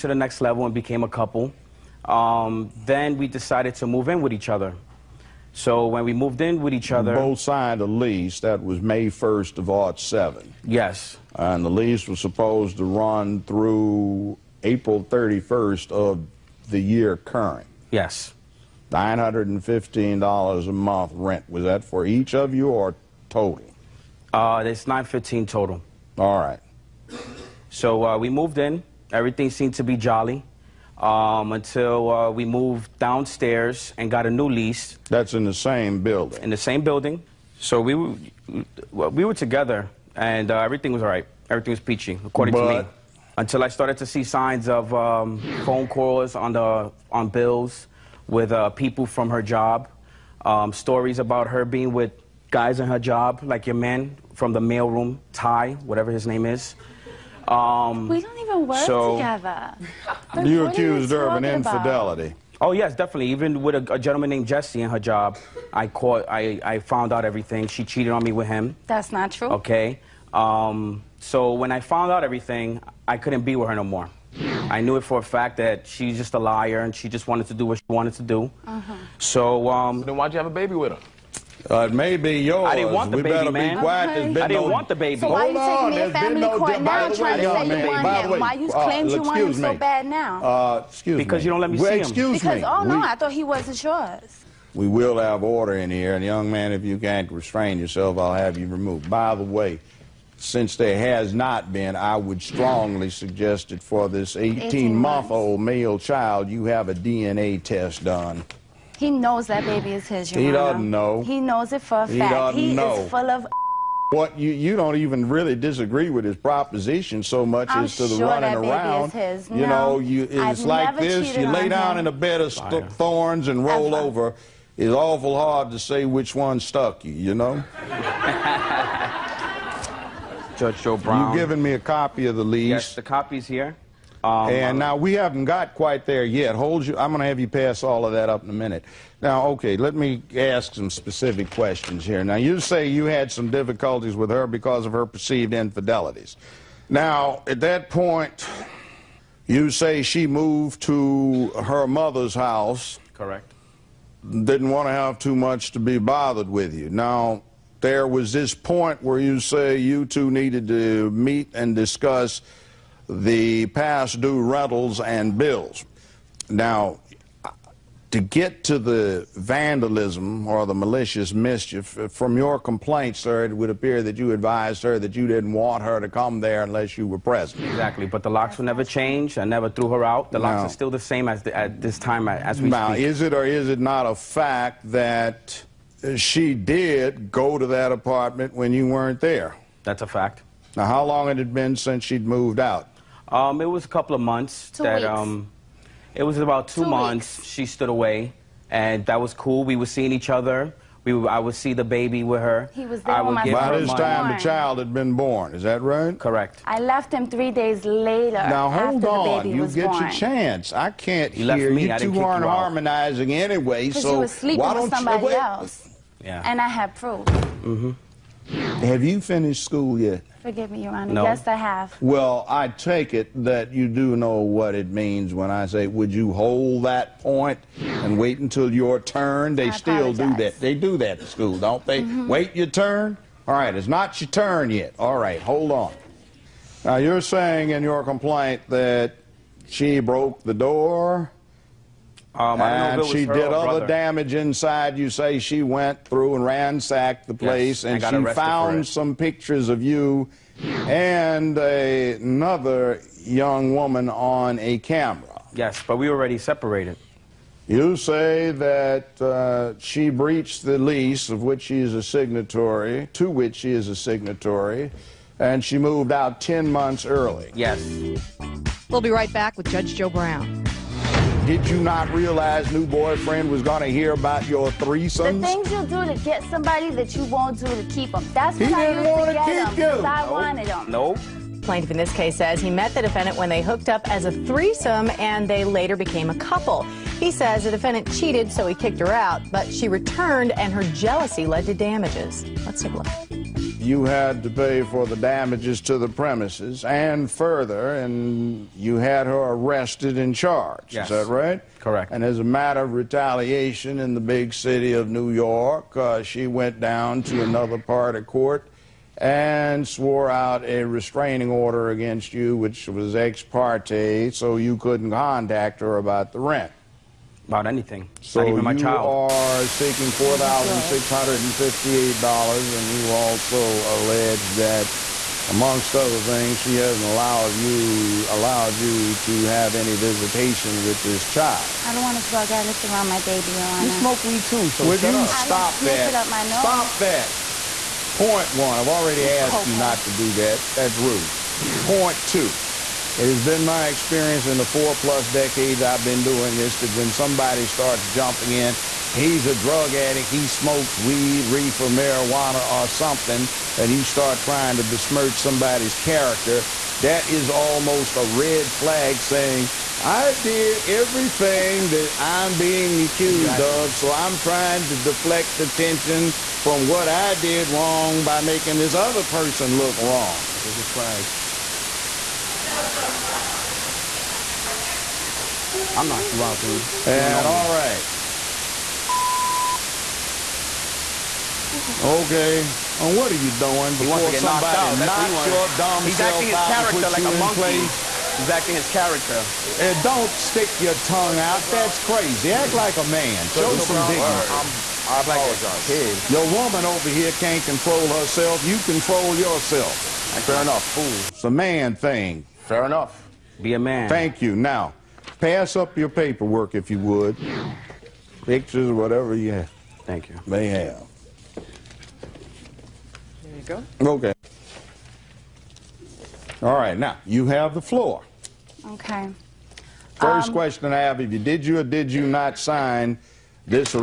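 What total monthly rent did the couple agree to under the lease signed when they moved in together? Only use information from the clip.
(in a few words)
$915.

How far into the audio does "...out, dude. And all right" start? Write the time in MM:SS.
06:16.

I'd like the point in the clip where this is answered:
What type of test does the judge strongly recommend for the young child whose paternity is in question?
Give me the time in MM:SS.
01:46.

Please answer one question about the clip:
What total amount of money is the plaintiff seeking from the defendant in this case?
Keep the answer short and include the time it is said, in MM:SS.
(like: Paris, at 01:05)
$4,658, at 05:20.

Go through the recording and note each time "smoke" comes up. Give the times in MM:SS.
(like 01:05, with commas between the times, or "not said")
05:33, 05:50.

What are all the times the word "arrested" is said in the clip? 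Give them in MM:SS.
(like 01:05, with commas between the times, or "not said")
04:59.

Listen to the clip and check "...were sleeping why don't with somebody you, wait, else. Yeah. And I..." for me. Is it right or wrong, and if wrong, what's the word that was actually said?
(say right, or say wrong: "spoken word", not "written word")
right.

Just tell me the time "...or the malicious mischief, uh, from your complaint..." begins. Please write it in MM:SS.
02:50.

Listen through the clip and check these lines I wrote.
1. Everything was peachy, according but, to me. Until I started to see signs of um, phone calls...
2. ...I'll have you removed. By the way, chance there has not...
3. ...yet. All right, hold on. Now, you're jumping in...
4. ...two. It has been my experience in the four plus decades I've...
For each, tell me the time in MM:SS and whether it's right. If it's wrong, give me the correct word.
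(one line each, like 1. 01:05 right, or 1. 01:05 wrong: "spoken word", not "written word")
1. 00:41 right
2. 01:38 wrong: "since", not "chance"
3. 03:54 wrong: "saying", not "jumping"
4. 05:42 right.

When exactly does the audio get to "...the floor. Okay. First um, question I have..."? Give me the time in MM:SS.
06:57.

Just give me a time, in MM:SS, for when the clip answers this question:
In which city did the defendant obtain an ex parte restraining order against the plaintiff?
05:05.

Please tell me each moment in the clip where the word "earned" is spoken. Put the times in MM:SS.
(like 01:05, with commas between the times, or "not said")
not said.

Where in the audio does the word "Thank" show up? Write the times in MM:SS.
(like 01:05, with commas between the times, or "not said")
06:44, 06:50.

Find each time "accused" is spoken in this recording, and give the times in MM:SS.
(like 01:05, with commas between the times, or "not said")
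01:00, 06:03.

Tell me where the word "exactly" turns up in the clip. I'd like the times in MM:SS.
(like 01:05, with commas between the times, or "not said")
02:57, 06:03.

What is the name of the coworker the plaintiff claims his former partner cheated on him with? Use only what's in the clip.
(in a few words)
Jesse.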